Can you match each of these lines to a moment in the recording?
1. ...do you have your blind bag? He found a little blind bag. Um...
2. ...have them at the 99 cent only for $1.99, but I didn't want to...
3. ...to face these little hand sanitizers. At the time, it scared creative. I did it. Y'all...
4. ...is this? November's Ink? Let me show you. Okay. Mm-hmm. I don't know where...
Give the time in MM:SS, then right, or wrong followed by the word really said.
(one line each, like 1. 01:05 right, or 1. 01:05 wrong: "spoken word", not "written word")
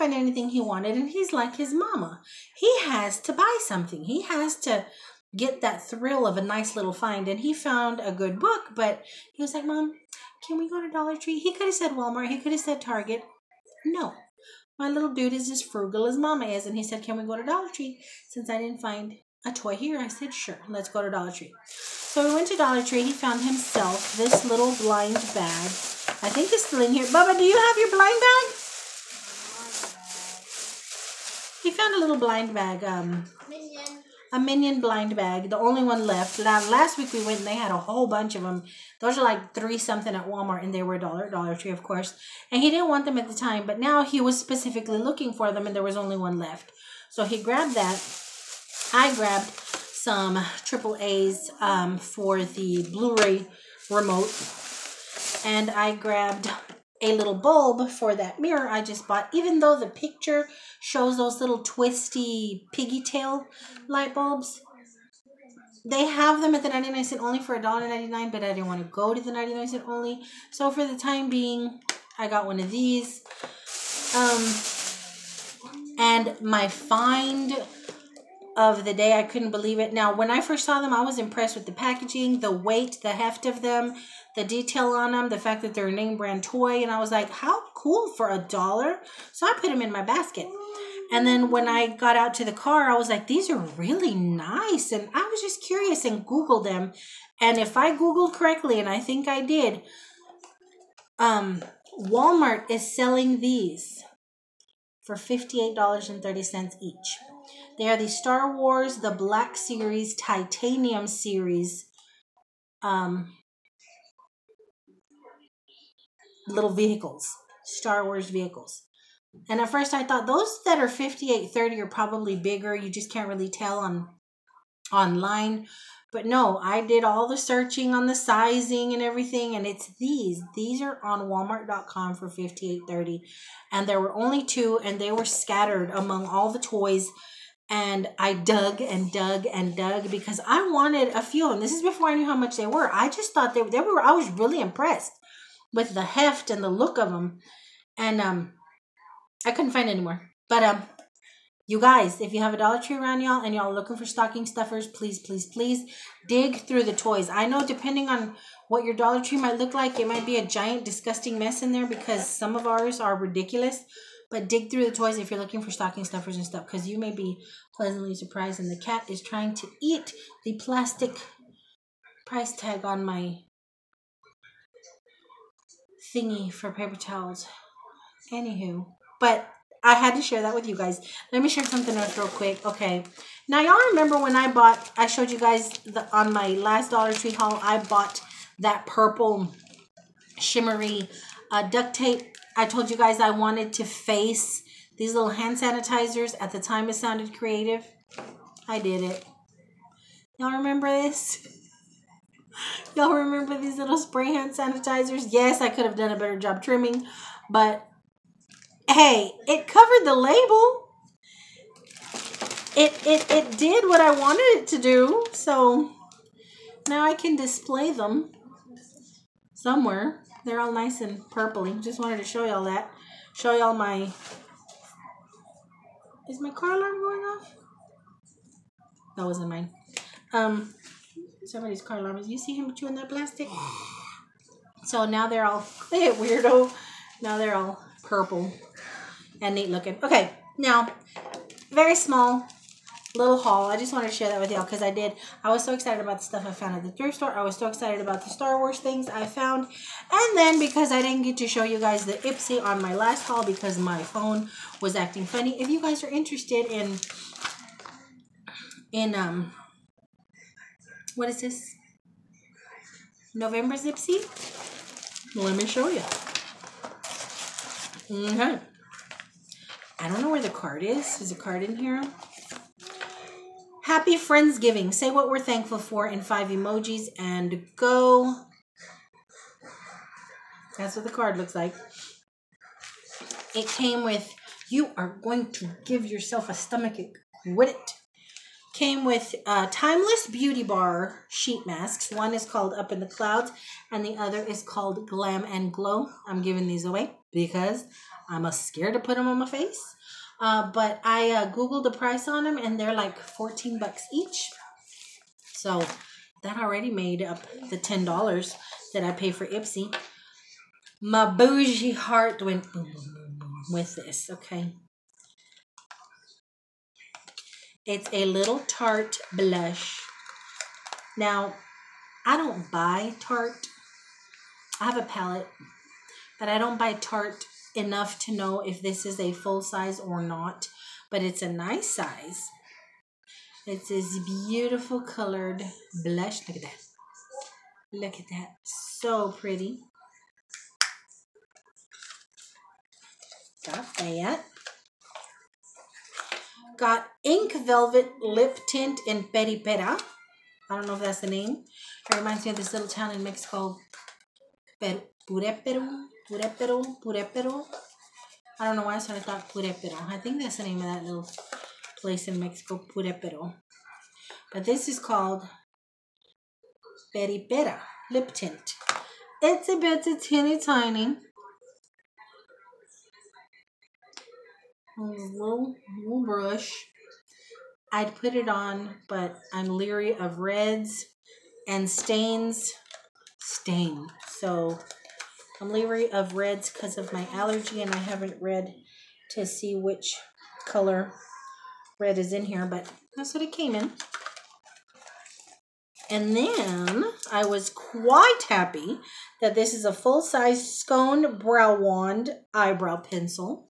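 1. 00:27 right
2. 01:06 right
3. 03:13 wrong: "sounded", not "scared"
4. 04:21 wrong: "Ipsy", not "Ink".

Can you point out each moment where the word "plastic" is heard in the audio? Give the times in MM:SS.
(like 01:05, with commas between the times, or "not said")
02:50, 03:53.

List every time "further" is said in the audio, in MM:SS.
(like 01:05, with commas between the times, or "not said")
not said.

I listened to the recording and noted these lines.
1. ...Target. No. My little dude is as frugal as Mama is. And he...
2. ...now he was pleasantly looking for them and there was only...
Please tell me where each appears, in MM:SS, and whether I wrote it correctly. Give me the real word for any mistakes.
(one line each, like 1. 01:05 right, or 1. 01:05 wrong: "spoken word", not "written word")
1. 00:12 right
2. 00:43 wrong: "specifically", not "pleasantly".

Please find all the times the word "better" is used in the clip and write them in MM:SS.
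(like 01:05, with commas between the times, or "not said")
03:26.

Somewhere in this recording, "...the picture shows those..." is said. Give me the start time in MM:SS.
00:59.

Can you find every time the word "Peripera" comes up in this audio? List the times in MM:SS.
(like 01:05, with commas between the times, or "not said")
05:49, 06:07.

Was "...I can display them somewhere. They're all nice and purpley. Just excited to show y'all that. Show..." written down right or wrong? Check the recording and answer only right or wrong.
wrong.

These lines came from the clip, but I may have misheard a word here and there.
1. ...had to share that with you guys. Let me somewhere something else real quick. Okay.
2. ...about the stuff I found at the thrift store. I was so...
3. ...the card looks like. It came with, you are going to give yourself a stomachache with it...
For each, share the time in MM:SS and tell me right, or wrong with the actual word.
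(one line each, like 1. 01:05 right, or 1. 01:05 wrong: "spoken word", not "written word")
1. 02:59 wrong: "share", not "somewhere"
2. 04:06 right
3. 04:41 right.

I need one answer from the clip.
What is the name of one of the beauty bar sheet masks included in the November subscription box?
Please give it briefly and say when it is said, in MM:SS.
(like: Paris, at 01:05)
Up in the Clouds, at 04:52.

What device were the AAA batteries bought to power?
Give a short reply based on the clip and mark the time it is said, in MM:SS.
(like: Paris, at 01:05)
Blu-ray remote, at 00:52.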